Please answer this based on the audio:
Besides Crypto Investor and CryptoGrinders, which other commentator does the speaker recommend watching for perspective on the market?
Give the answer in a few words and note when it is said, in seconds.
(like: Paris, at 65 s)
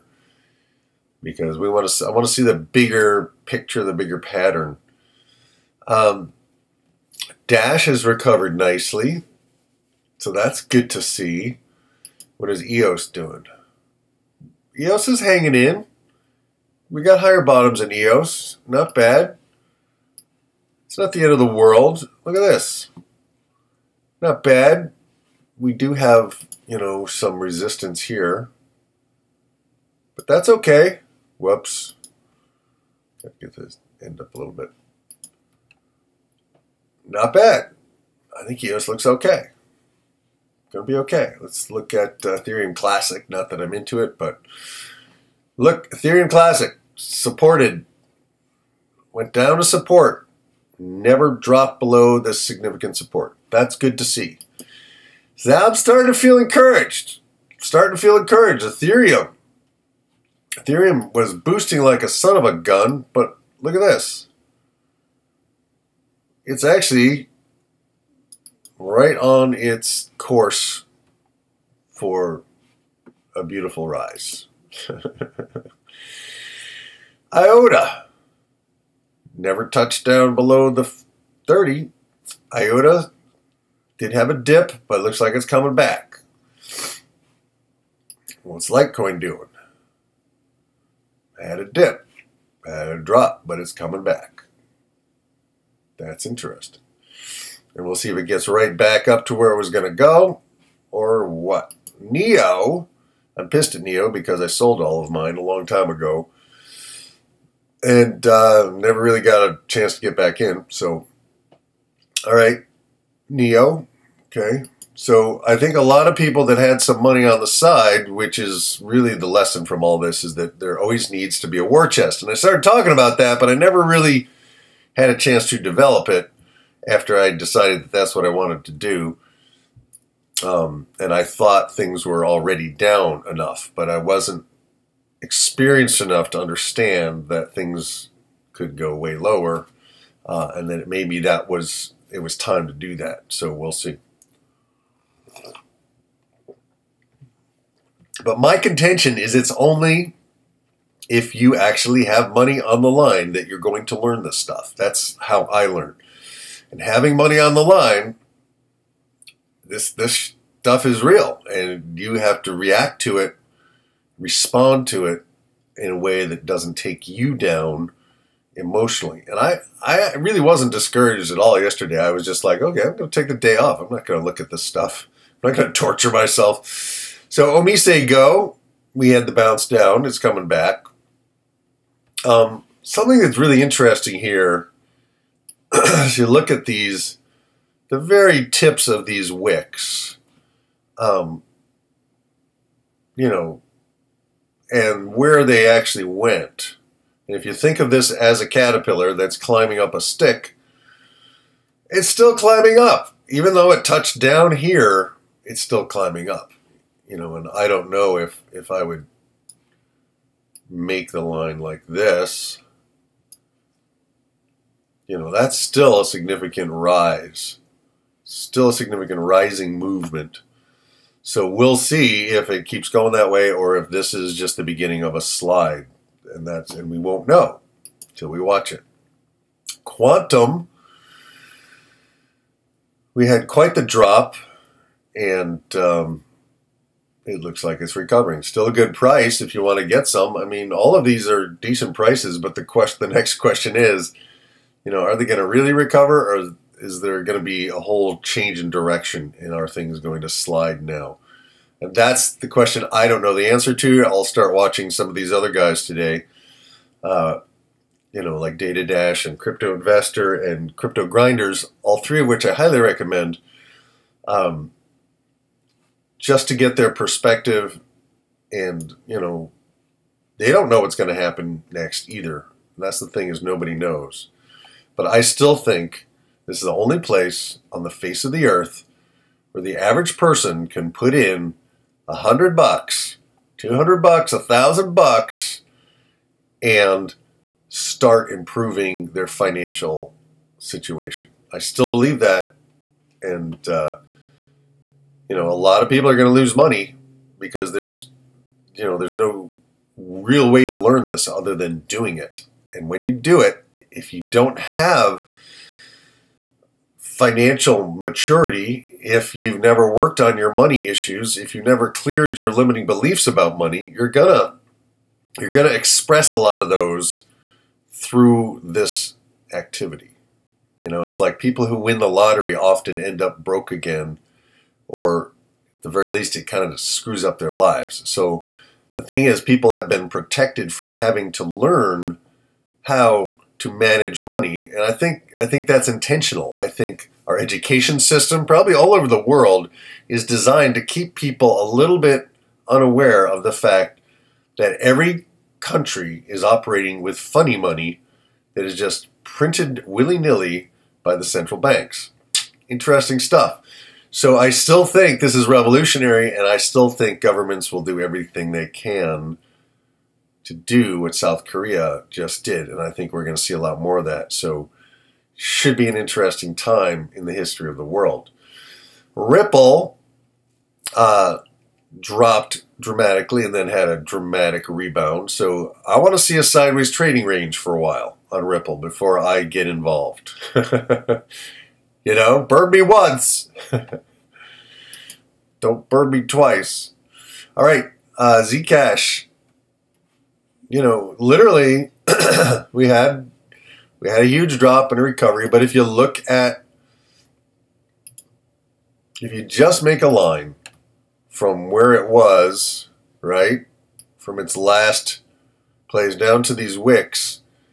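DataDash, at 258 s.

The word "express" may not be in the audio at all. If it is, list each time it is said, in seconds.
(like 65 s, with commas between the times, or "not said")
315 s.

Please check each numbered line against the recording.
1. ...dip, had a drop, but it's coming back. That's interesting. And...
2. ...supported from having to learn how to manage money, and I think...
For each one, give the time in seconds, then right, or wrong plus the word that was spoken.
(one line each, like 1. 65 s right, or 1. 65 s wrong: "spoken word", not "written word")
1. 91 s right
2. 330 s wrong: "protected", not "supported".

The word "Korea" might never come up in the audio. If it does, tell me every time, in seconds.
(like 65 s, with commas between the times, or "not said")
361 s.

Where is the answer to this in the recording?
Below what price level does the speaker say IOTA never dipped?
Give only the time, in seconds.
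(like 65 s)
80 s.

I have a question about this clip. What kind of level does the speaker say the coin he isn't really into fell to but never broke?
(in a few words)
significant support.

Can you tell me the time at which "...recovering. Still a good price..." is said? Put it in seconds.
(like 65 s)
237 s.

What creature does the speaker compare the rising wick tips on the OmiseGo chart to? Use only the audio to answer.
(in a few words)
caterpillar.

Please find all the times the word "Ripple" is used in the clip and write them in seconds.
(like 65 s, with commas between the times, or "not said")
369 s, 378 s.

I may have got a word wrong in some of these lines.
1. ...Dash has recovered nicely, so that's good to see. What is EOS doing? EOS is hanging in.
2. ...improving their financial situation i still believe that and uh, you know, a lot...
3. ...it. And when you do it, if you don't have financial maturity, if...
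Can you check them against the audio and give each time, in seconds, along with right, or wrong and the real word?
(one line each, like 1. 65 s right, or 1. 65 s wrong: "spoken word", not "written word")
1. 7 s right
2. 288 s right
3. 302 s right.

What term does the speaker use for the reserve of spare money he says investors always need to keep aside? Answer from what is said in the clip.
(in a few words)
war chest.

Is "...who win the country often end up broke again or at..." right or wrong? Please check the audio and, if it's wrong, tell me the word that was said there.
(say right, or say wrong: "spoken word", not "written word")
wrong: "lottery", not "country".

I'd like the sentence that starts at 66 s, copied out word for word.
It's actually right on its course for a beautiful rise.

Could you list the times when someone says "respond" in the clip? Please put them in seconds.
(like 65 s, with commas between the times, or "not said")
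164 s.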